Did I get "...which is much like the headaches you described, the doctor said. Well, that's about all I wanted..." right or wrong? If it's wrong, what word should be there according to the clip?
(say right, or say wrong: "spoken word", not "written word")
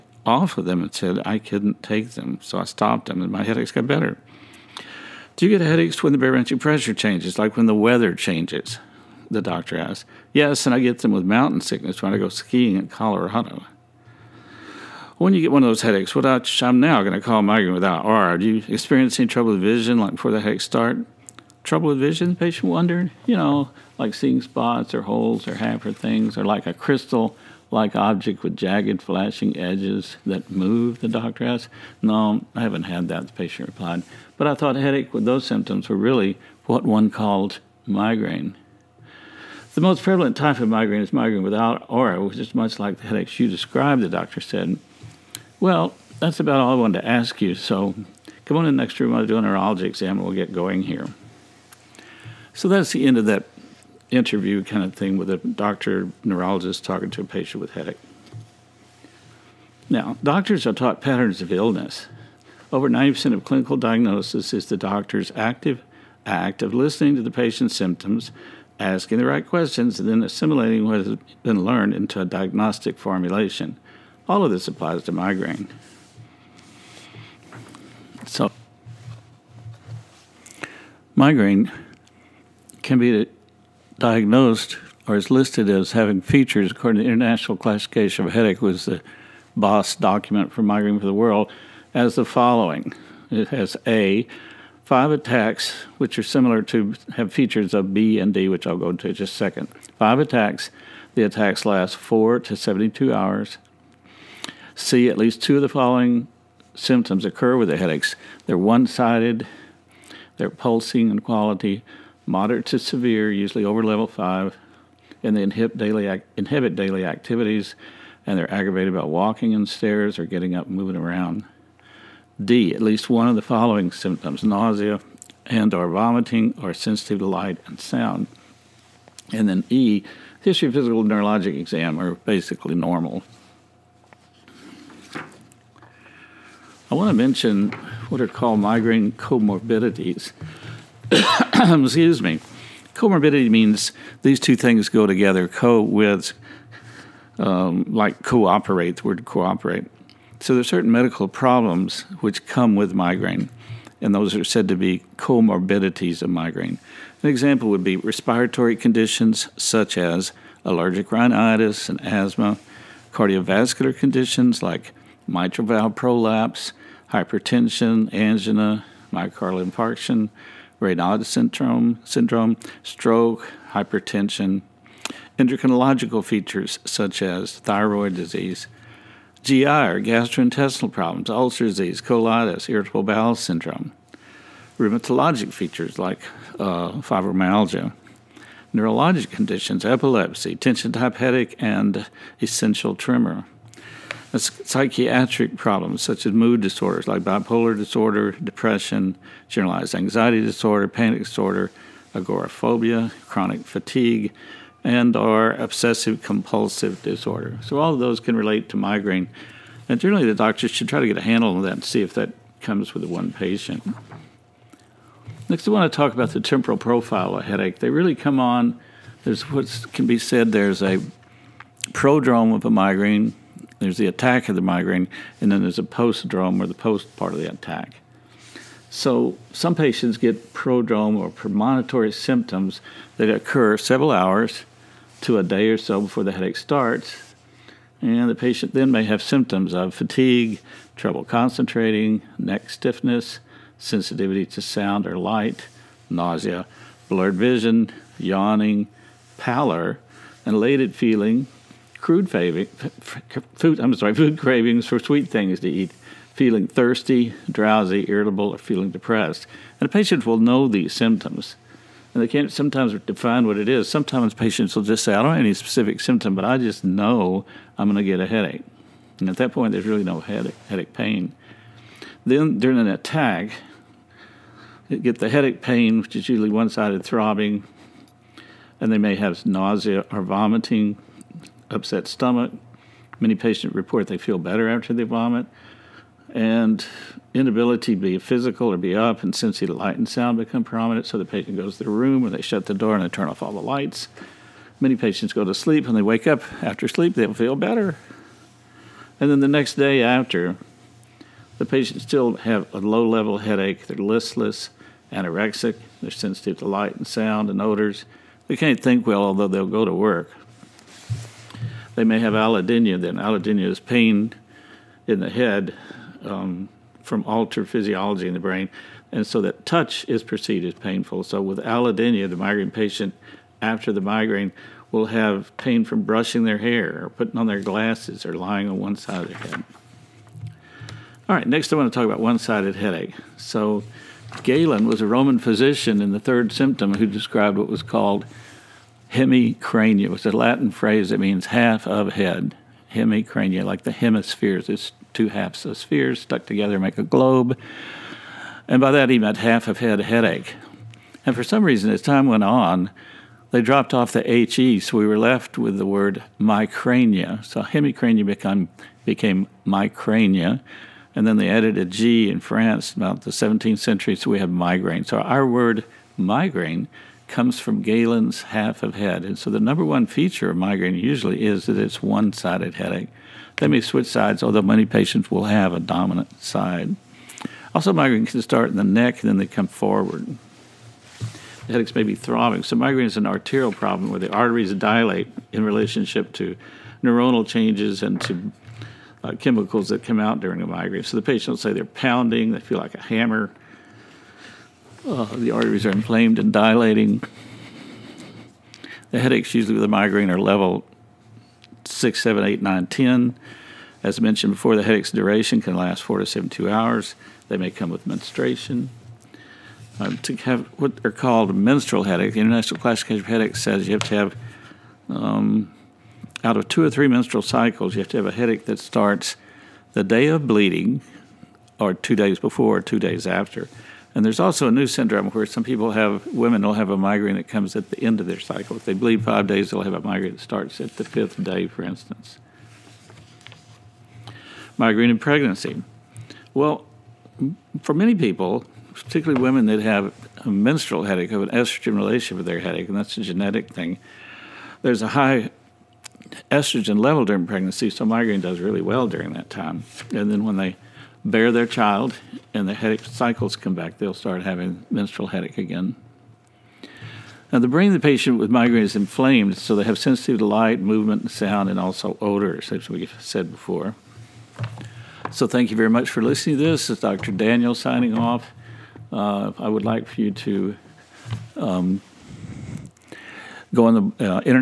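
right.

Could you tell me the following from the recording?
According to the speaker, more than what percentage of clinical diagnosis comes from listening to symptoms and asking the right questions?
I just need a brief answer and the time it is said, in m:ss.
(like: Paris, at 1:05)
90%, at 1:02.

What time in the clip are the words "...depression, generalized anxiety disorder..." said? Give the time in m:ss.
3:18.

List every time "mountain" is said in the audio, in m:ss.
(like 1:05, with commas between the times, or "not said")
0:11.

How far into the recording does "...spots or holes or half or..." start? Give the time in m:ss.
0:24.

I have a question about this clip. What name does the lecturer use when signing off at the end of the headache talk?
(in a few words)
Dr. Daniel.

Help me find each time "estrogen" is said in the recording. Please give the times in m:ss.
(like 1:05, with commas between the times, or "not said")
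7:21, 7:26.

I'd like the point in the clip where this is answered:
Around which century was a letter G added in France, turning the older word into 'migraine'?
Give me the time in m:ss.
6:03.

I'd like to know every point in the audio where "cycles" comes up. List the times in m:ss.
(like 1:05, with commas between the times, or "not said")
6:57, 7:08, 7:33.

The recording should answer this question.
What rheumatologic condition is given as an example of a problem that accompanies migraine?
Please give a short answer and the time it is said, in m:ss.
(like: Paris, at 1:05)
Fibromyalgia, at 3:07.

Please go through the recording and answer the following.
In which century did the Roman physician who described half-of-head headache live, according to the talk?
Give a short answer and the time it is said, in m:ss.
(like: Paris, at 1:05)
Third, at 5:36.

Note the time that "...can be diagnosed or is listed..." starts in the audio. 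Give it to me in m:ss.
1:22.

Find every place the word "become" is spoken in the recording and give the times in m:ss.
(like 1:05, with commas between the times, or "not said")
4:50, 5:58.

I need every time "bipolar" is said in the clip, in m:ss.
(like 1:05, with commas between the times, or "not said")
3:17.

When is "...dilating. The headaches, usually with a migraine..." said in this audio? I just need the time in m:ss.
6:36.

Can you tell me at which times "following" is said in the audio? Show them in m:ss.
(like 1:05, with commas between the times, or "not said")
1:32, 1:45, 2:03.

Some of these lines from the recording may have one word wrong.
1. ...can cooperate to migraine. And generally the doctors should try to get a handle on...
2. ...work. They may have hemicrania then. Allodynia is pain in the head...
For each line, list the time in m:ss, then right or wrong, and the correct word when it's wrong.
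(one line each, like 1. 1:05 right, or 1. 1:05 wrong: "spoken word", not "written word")
1. 3:28 wrong: "relate", not "cooperate"
2. 5:09 wrong: "allodynia", not "hemicrania".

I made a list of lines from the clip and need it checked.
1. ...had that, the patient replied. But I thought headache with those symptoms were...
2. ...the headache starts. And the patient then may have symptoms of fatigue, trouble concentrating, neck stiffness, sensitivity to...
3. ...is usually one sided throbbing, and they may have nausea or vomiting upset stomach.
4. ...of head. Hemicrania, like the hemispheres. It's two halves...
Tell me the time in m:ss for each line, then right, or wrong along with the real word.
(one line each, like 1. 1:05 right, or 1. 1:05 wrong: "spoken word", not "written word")
1. 0:32 right
2. 3:56 right
3. 4:36 right
4. 5:41 right.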